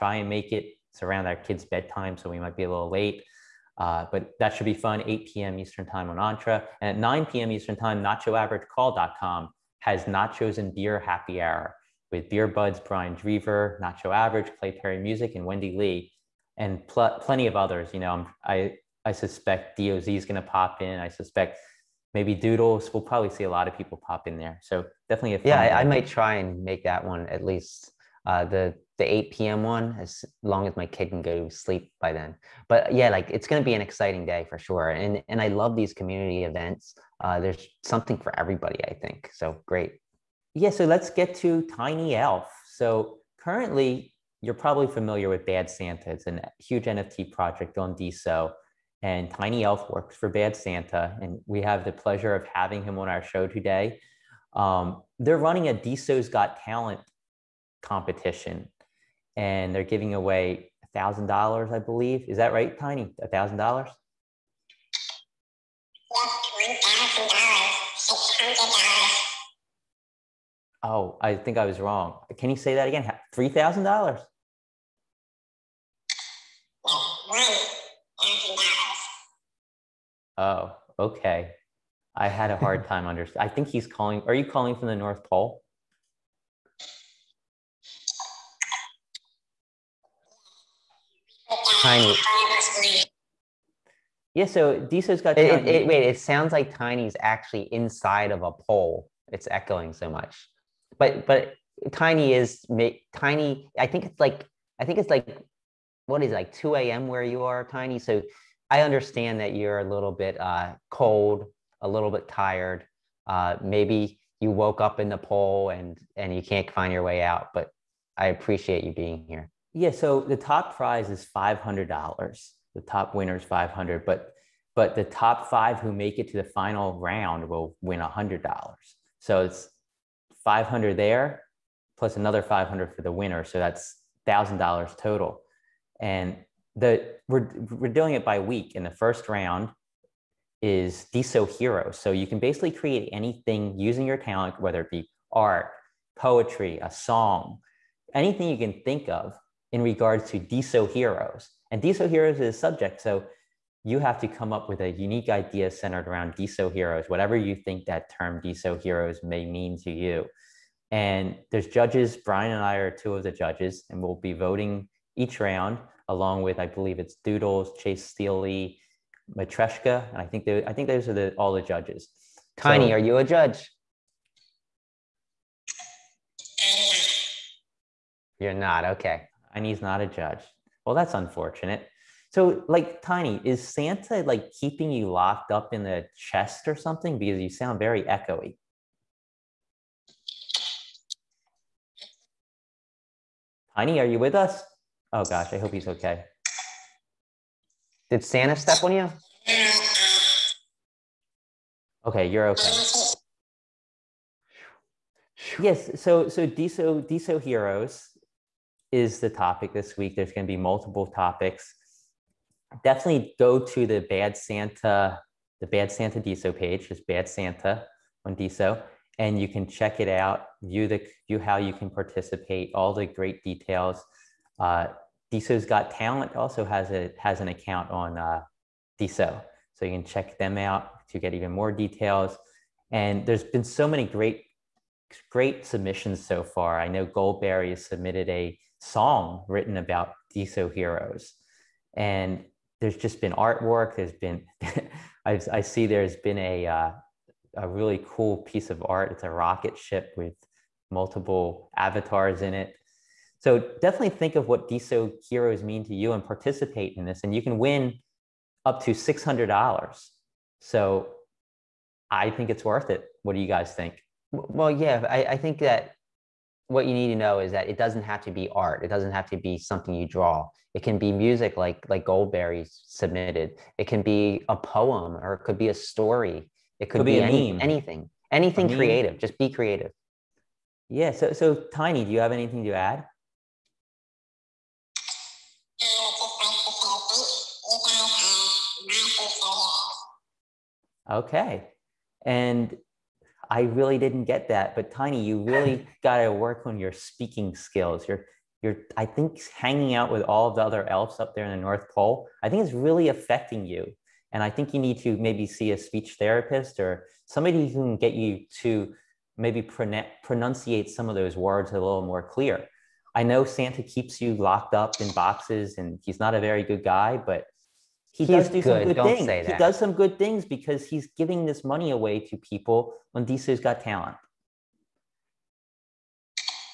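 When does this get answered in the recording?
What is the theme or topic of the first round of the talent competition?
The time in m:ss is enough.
2:18.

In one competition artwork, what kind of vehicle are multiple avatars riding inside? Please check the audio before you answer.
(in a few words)
rocket ship.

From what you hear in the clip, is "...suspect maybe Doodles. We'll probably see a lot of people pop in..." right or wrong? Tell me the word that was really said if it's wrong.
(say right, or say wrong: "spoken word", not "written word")
right.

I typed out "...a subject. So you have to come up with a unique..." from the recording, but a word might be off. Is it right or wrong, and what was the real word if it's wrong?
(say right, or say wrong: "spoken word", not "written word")
right.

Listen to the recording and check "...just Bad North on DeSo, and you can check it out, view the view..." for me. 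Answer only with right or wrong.
wrong.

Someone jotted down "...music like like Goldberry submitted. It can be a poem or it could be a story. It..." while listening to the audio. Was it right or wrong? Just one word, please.
right.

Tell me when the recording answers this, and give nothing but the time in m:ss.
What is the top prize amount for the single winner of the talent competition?
2:02.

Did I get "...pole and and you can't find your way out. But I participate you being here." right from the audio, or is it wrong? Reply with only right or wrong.
wrong.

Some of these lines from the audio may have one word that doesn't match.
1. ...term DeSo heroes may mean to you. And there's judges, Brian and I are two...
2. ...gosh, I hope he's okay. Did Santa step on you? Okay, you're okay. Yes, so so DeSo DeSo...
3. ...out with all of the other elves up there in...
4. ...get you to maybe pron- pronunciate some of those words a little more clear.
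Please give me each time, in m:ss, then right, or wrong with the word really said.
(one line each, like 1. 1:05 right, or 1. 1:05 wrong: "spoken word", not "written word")
1. 2:38 right
2. 3:15 right
3. 4:59 right
4. 5:07 right.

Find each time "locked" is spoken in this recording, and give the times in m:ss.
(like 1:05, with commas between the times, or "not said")
3:05, 5:14.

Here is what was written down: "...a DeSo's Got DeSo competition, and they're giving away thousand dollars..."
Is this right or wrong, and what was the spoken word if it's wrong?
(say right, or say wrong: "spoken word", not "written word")
wrong: "Talent", not "DeSo".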